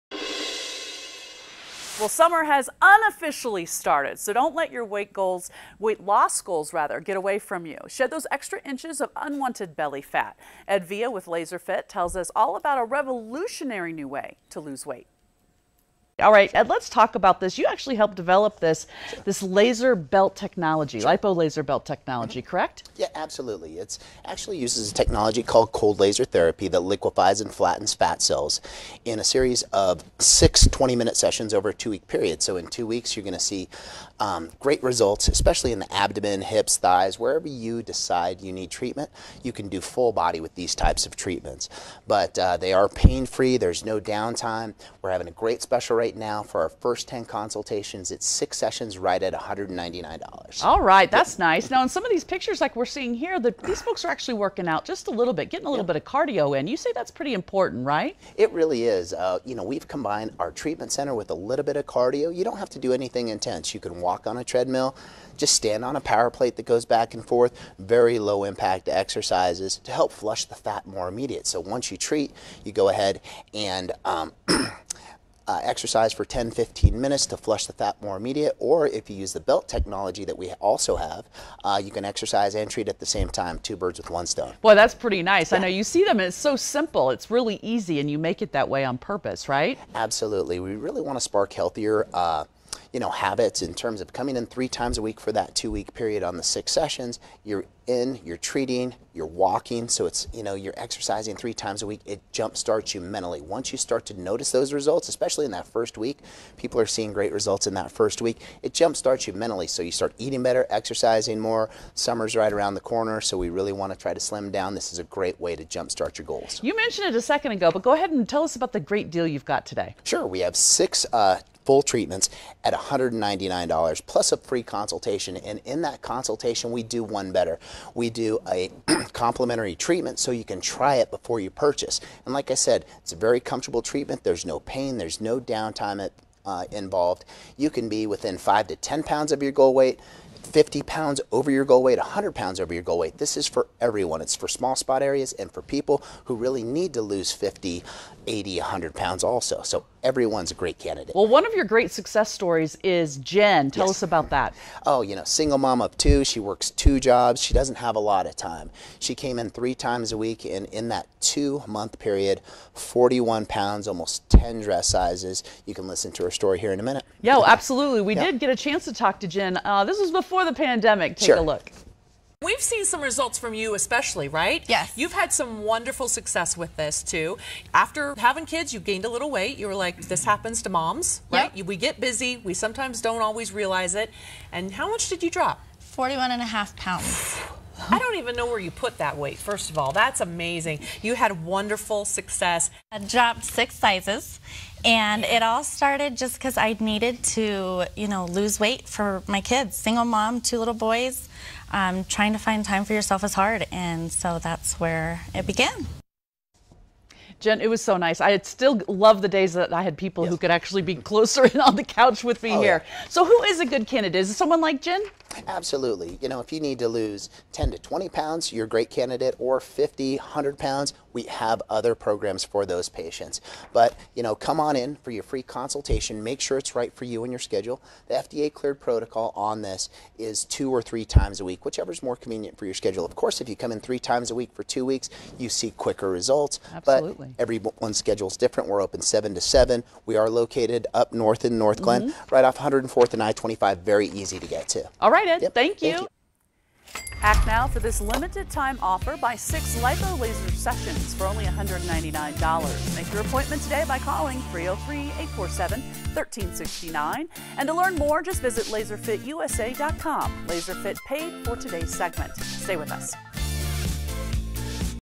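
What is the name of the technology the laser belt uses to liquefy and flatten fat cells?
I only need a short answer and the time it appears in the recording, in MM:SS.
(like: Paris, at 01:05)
cold laser therapy, at 00:25.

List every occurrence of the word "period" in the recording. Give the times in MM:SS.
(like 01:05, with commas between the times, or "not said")
00:32, 01:35, 02:41.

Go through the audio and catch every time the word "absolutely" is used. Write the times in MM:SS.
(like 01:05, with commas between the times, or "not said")
00:23, 01:29, 02:47, 03:35, 03:56.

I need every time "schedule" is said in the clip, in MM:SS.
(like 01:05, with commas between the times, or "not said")
03:47, 03:52, 03:57.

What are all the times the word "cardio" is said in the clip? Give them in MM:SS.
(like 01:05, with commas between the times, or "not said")
00:56, 01:01.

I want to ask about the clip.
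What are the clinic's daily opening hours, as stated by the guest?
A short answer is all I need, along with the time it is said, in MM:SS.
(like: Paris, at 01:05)
7 to 7, at 03:59.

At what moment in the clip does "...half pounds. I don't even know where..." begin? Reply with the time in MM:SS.
03:06.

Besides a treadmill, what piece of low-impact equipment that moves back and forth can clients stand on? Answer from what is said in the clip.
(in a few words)
power plate.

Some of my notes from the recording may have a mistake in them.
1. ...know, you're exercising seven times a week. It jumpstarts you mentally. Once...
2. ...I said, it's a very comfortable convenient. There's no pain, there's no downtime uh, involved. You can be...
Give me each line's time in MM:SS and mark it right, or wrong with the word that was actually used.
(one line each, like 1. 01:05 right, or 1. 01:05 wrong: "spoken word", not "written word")
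1. 01:40 wrong: "three", not "seven"
2. 02:12 wrong: "treatment", not "convenient".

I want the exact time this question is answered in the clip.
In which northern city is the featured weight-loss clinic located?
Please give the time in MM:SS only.
04:01.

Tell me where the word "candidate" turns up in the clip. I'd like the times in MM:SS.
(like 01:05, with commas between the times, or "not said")
02:30, 03:33, 03:38.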